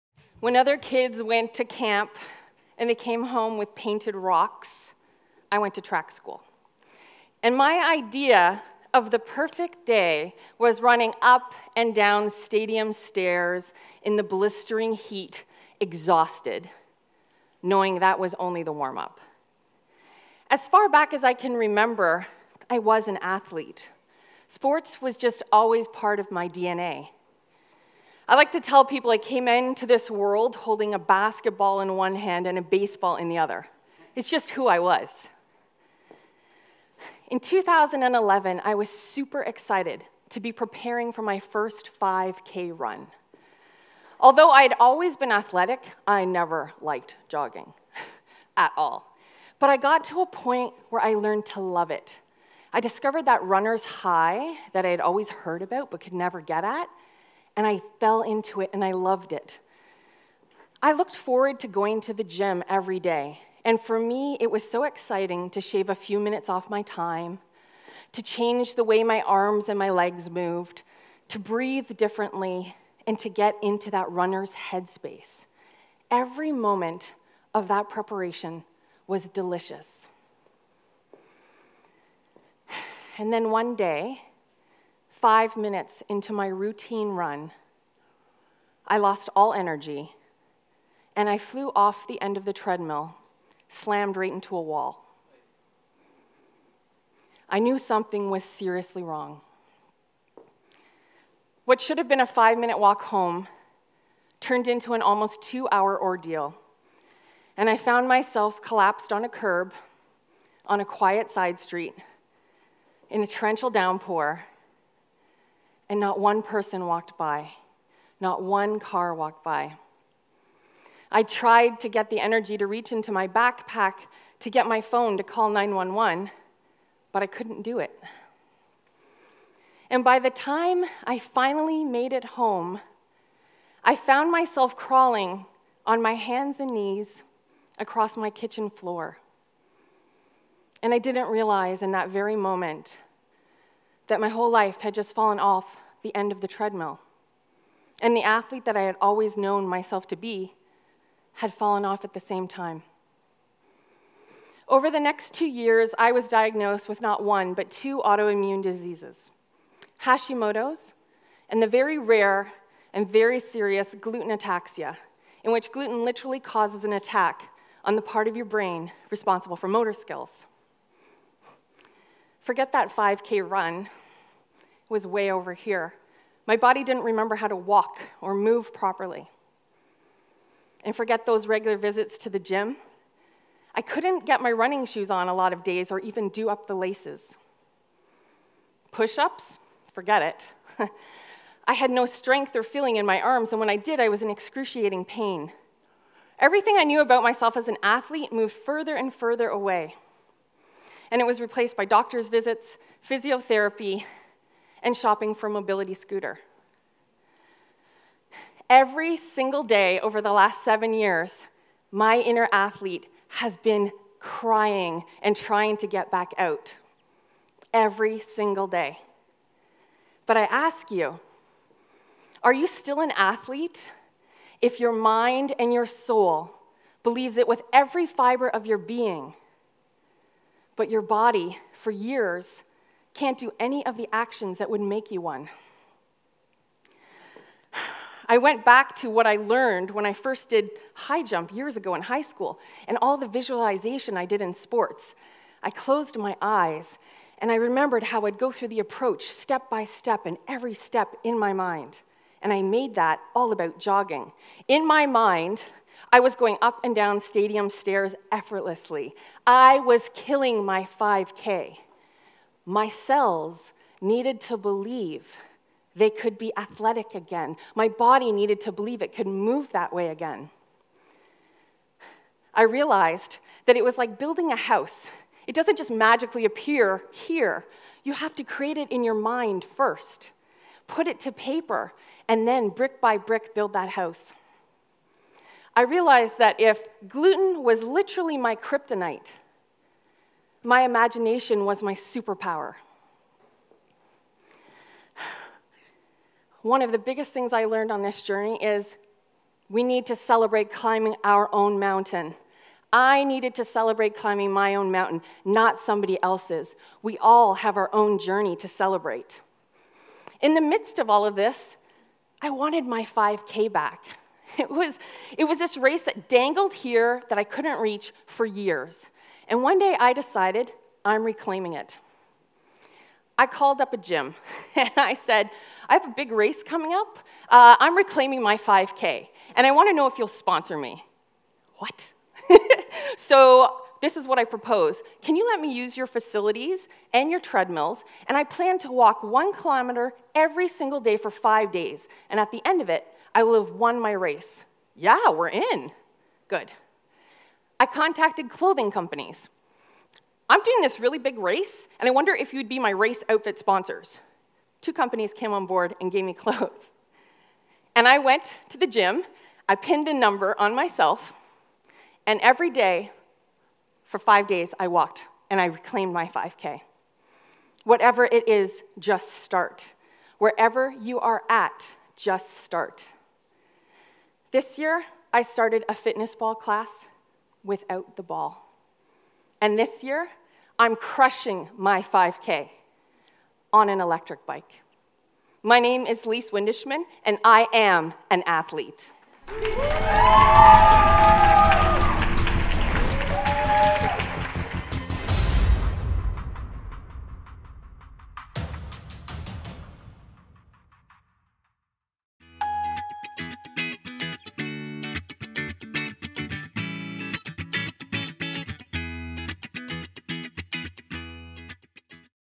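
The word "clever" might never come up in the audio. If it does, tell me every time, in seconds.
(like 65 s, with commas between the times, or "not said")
not said.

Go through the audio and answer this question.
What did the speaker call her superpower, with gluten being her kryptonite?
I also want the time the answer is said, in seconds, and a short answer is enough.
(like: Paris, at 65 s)
imagination, at 290 s.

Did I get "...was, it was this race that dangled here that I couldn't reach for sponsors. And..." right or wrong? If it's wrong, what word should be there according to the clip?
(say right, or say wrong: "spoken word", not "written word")
wrong: "years", not "sponsors".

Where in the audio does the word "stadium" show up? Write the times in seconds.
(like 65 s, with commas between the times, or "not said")
12 s, 257 s.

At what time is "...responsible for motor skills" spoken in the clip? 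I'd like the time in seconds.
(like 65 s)
169 s.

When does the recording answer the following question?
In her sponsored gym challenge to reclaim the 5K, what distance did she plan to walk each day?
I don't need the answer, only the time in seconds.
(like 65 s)
339 s.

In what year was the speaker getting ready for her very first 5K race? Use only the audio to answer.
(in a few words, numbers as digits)
2011.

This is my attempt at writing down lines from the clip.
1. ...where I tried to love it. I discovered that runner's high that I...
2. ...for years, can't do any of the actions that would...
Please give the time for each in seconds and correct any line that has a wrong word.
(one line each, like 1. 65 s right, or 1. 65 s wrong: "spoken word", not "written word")
1. 50 s wrong: "learned", not "tried"
2. 231 s right.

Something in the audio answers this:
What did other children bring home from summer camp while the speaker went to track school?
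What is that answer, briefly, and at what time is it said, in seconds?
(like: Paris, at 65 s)
painted rocks, at 3 s.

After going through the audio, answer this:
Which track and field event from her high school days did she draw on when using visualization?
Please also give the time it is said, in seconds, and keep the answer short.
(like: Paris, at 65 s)
high jump, at 240 s.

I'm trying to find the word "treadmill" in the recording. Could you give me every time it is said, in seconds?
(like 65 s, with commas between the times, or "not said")
92 s, 146 s, 337 s.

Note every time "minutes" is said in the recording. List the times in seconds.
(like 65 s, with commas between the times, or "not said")
66 s, 85 s, 102 s.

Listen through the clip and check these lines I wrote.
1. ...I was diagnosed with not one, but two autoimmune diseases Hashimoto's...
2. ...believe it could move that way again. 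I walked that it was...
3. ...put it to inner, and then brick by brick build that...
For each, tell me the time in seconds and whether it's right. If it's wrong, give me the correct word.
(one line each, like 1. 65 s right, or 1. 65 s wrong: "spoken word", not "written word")
1. 155 s right
2. 268 s wrong: "realized", not "walked"
3. 280 s wrong: "paper", not "inner".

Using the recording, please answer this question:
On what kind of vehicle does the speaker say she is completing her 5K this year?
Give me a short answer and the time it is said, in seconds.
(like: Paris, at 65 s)
electric bike, at 384 s.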